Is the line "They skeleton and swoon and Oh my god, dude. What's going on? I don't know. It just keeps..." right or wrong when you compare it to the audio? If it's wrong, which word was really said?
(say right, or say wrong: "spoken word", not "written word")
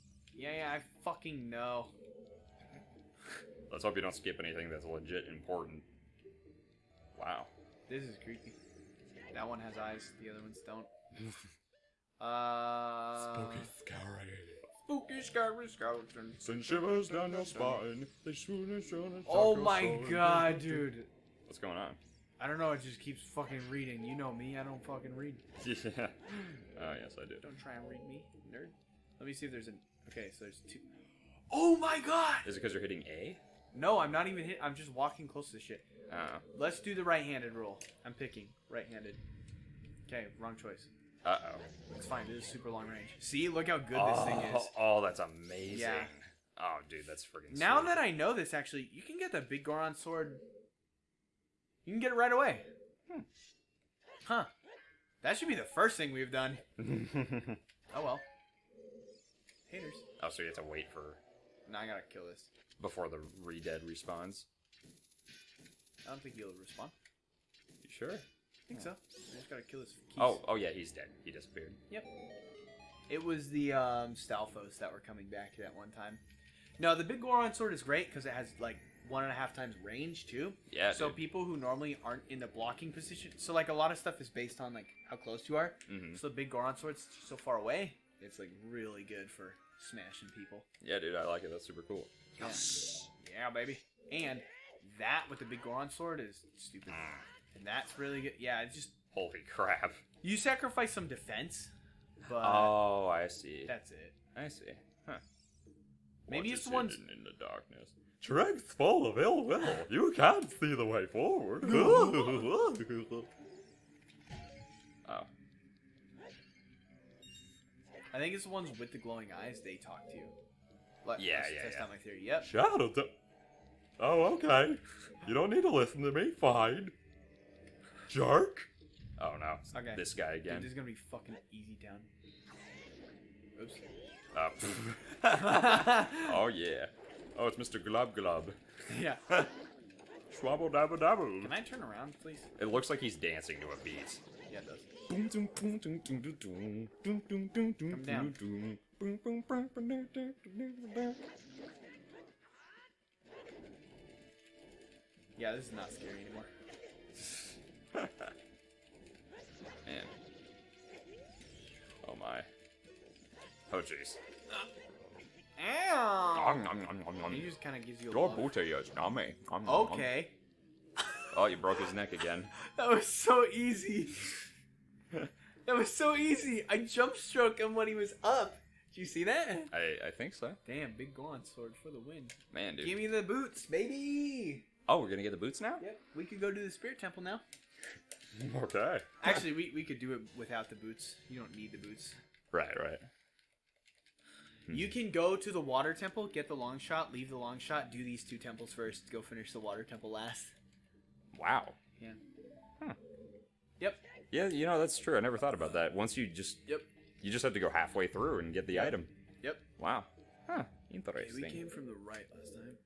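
wrong: "swoon", not "skeleton".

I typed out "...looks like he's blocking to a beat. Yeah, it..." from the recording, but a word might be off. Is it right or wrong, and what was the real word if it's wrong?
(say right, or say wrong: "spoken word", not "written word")
wrong: "dancing", not "blocking".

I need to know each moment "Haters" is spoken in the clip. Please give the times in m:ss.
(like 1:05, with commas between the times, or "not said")
0:59.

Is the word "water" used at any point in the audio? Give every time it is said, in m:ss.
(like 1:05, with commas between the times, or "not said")
3:15, 3:19.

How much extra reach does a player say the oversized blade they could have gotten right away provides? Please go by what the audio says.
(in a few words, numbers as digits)
1.5 times range.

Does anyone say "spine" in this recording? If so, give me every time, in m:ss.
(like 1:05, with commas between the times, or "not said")
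0:17.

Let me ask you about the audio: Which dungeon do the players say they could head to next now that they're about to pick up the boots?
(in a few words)
Spirit Temple.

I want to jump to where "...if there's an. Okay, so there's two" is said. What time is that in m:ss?
0:29.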